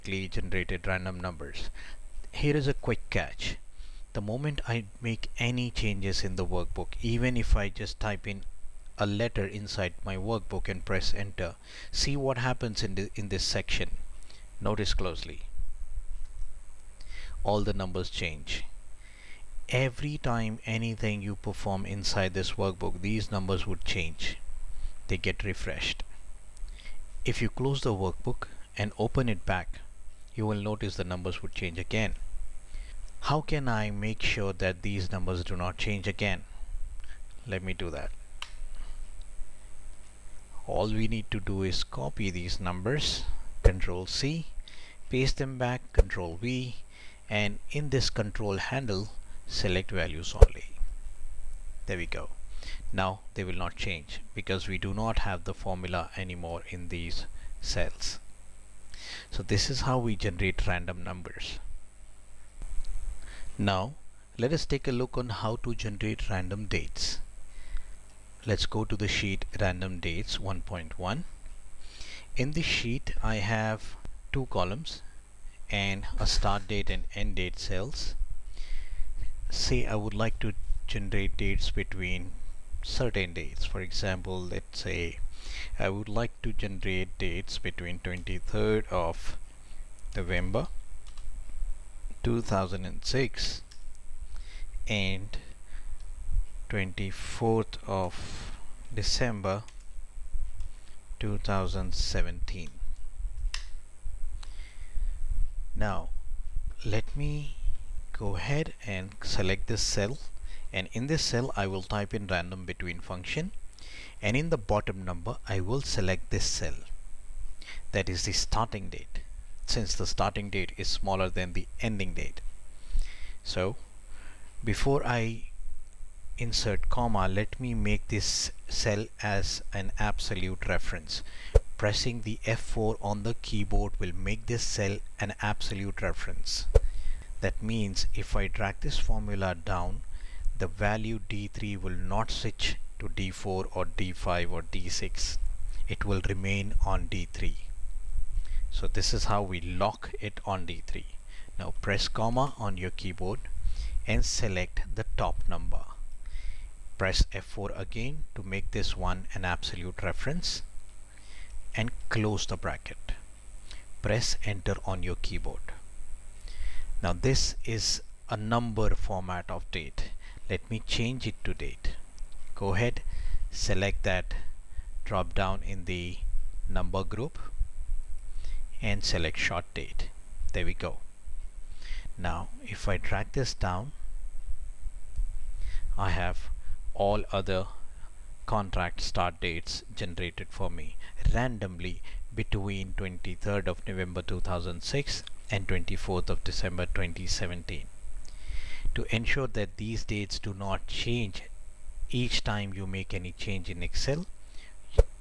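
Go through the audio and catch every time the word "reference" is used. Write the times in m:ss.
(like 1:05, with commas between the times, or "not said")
2:10, 2:16, 2:40.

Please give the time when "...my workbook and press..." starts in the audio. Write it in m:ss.
0:10.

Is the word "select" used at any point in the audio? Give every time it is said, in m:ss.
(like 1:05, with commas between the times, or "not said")
0:49, 1:49, 1:55, 2:34, 2:53, 2:59.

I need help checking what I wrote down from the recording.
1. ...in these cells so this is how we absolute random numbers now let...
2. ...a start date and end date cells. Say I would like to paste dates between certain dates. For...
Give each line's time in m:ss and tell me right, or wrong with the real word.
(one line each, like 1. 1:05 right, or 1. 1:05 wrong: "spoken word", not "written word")
1. 0:56 wrong: "generate", not "absolute"
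2. 1:16 wrong: "generate", not "paste".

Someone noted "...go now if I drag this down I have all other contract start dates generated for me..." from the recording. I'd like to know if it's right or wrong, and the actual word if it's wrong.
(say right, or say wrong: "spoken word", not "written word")
right.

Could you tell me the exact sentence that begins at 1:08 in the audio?
Let's go to the sheet random dates 1.1.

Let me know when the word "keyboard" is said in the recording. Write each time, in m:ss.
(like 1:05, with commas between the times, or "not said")
2:13, 2:32, 2:45.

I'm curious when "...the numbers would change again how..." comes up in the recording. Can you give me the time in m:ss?
0:30.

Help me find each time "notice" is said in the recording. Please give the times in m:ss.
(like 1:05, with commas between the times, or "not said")
0:14, 0:30.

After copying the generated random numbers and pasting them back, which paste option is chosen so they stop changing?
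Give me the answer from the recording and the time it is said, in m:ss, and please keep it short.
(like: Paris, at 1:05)
values only, at 0:49.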